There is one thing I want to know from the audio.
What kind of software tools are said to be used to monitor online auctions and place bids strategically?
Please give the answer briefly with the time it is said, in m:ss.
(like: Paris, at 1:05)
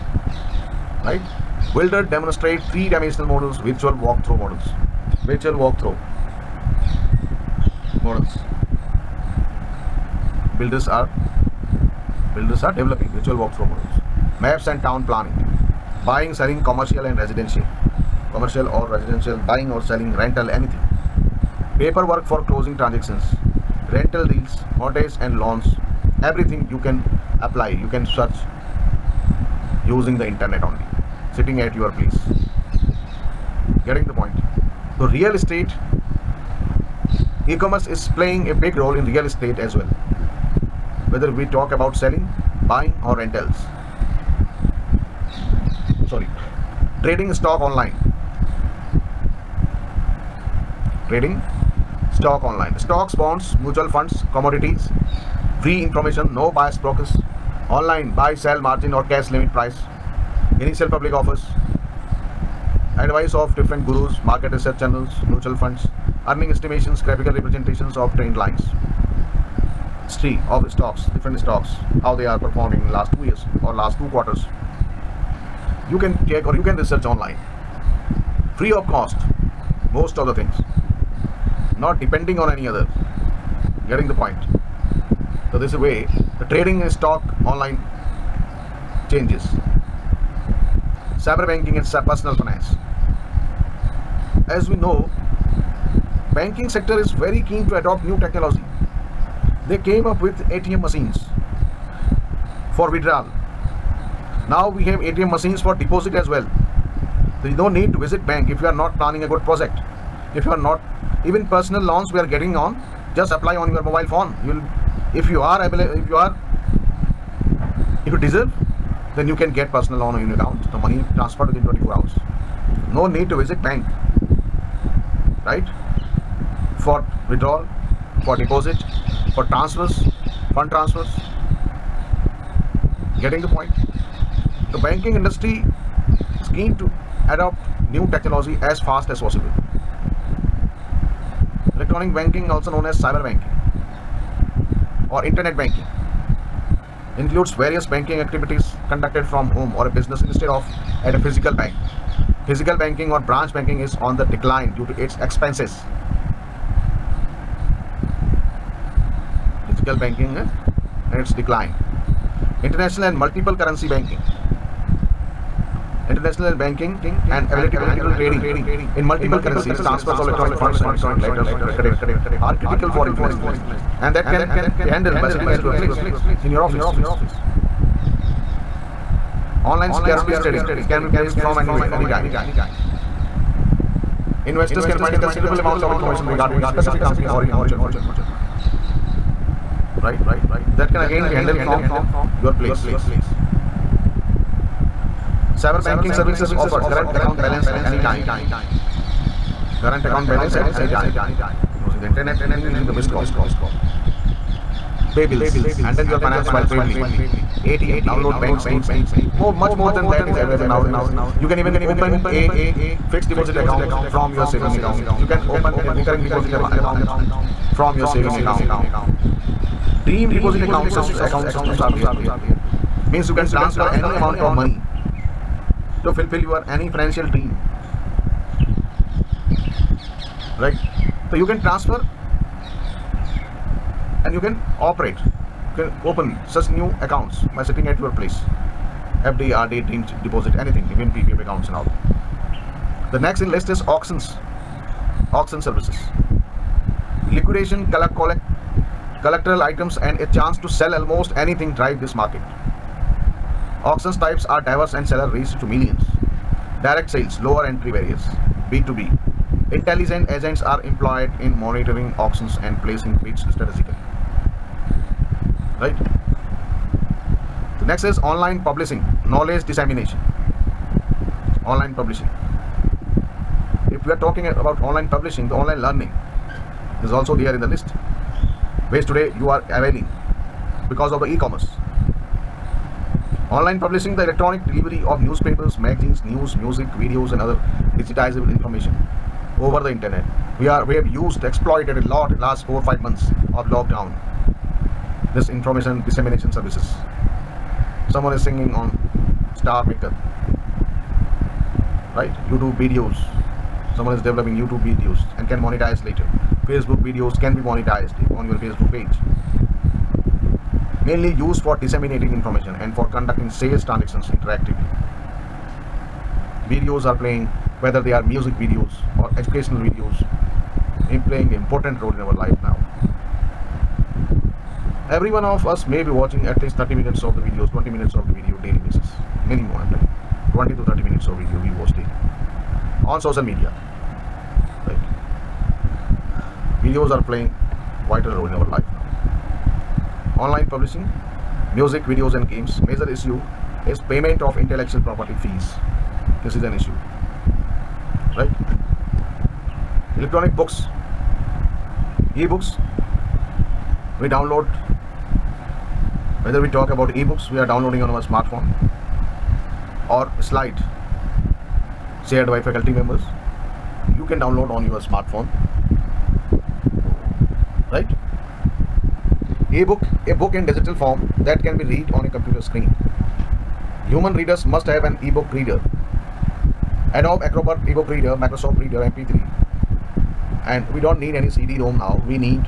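Intelligent agents, at 4:19.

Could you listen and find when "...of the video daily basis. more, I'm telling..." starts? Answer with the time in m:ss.
5:28.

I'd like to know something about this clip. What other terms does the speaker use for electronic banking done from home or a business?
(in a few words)
Cyber banking or internet banking.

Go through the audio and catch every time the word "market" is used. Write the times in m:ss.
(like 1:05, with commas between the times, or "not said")
1:04, 4:12.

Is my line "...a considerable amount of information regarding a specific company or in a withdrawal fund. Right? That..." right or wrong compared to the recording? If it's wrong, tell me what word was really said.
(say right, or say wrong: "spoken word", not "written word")
wrong: "mutual", not "withdrawal".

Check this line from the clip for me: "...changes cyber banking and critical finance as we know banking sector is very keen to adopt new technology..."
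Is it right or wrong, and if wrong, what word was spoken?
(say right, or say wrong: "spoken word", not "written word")
wrong: "personal", not "critical".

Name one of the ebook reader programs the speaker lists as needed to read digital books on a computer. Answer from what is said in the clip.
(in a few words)
Adobe Acrobat ebook reader.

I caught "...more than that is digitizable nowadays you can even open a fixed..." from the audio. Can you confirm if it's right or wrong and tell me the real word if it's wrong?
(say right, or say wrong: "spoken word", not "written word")
wrong: "available", not "digitizable".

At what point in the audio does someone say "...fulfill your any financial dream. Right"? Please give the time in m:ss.
3:46.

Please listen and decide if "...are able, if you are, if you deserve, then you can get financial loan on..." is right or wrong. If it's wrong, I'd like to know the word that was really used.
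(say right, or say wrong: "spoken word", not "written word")
wrong: "personal", not "financial".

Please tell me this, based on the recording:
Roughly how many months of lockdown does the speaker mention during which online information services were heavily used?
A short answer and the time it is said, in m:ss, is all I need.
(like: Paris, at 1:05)
4-5 months, at 4:52.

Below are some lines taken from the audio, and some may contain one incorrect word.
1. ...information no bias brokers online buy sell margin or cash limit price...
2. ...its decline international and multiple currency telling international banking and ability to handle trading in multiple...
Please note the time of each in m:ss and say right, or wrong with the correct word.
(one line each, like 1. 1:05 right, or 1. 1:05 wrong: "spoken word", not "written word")
1. 0:55 right
2. 2:41 wrong: "banking", not "telling".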